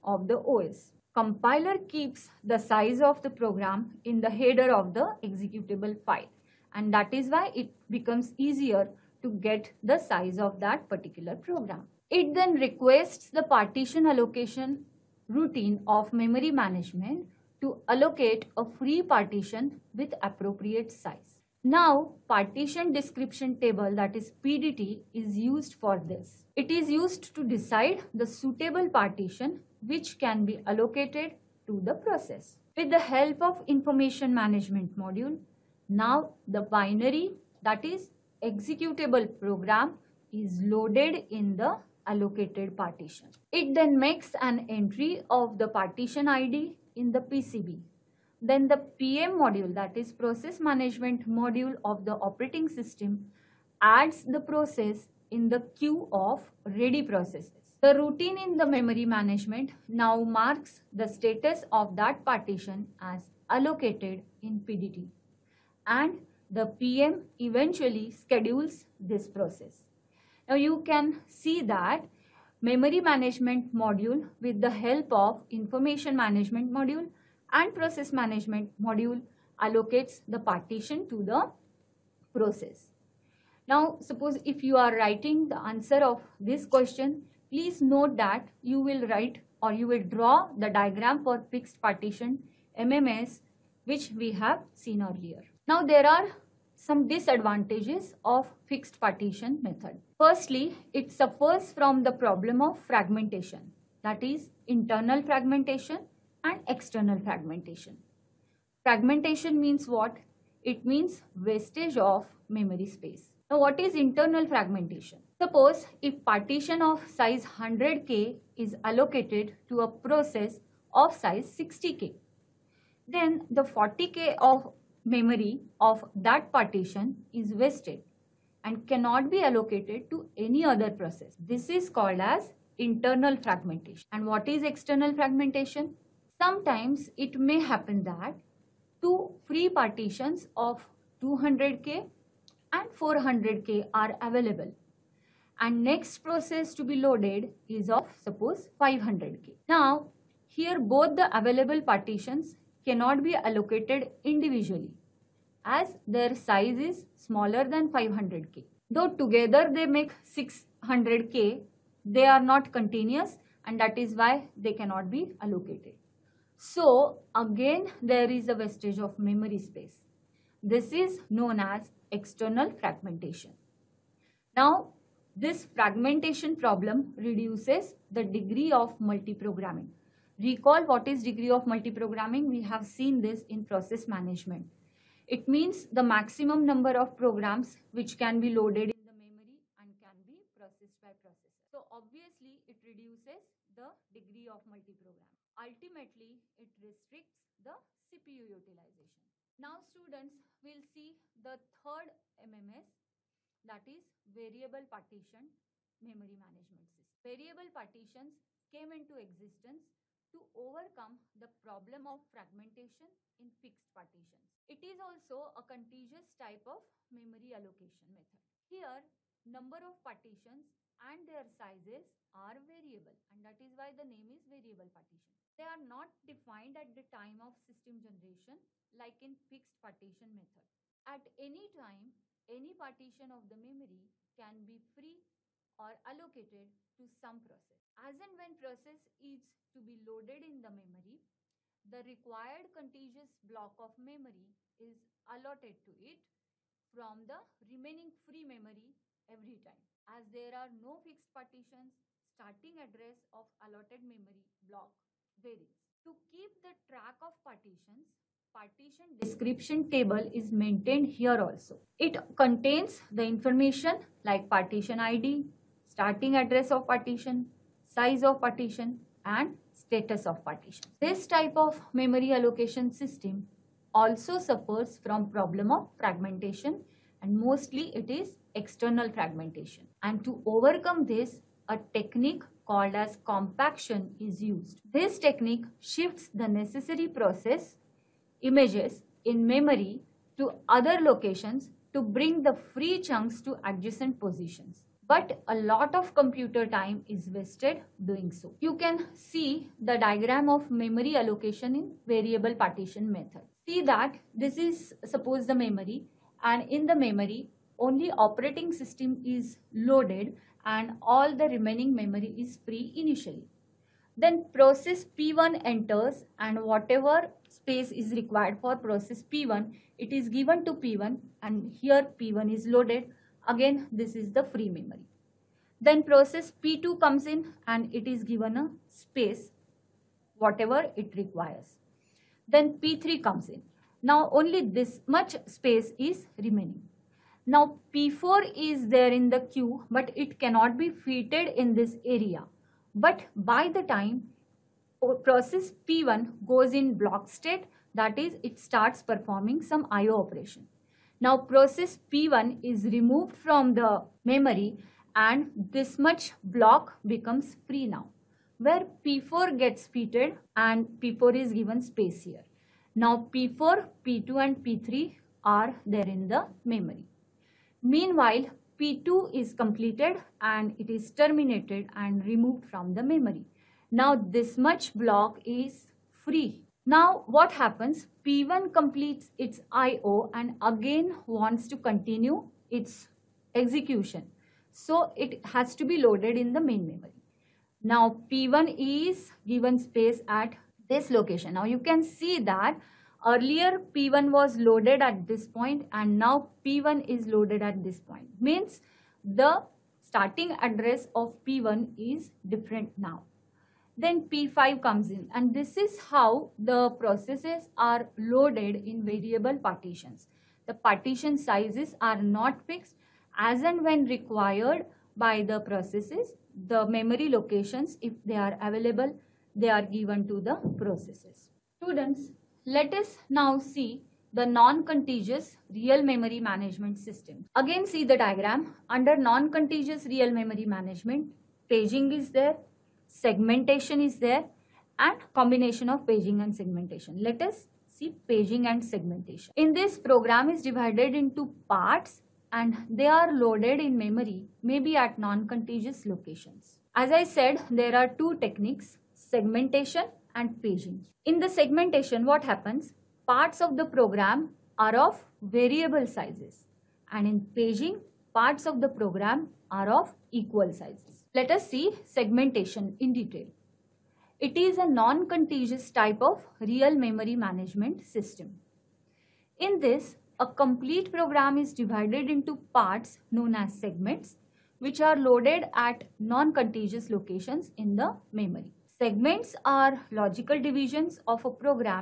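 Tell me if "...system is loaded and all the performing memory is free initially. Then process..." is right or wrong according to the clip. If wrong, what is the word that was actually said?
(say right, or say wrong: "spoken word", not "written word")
wrong: "remaining", not "performing".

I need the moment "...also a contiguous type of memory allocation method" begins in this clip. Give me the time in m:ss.
3:35.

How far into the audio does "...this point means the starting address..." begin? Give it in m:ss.
6:37.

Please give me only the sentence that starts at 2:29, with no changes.
Now here both the available partitions cannot be allocated individually as their size is smaller than 500k.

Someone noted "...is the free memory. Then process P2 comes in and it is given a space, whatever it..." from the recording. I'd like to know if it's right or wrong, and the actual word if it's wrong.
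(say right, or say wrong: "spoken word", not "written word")
right.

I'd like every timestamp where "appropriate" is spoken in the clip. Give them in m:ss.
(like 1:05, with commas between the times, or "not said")
0:20.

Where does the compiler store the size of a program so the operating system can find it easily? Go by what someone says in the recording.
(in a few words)
Header of the executable file.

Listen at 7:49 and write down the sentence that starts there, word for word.
In this, a complete program is divided into parts known as segments which are loaded at non-contiguous locations in the memory.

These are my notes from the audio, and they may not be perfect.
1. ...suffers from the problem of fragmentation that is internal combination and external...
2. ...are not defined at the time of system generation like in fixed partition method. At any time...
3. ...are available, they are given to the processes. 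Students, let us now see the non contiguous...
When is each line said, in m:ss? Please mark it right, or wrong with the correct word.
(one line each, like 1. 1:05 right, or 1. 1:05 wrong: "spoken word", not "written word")
1. 1:41 wrong: "fragmentation", not "combination"
2. 3:45 right
3. 6:58 right.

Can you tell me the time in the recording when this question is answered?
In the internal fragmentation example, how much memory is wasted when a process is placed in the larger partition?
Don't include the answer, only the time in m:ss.
2:03.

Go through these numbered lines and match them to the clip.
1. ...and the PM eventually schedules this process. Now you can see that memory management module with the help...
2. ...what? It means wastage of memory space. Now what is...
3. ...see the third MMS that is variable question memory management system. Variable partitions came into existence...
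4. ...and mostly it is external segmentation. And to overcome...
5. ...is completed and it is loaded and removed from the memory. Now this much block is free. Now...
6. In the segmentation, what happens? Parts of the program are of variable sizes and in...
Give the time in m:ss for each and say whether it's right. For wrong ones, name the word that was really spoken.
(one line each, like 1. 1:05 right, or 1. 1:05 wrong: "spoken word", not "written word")
1. 1:05 right
2. 1:49 right
3. 3:20 wrong: "partition", not "question"
4. 4:37 wrong: "fragmentation", not "segmentation"
5. 6:09 wrong: "terminated", not "loaded"
6. 7:31 right.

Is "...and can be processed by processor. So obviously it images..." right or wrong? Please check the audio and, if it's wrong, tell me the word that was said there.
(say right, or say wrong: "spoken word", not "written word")
wrong: "reduces", not "images".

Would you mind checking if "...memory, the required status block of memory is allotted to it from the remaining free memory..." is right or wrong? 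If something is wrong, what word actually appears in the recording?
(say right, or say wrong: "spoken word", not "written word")
wrong: "contiguous", not "status".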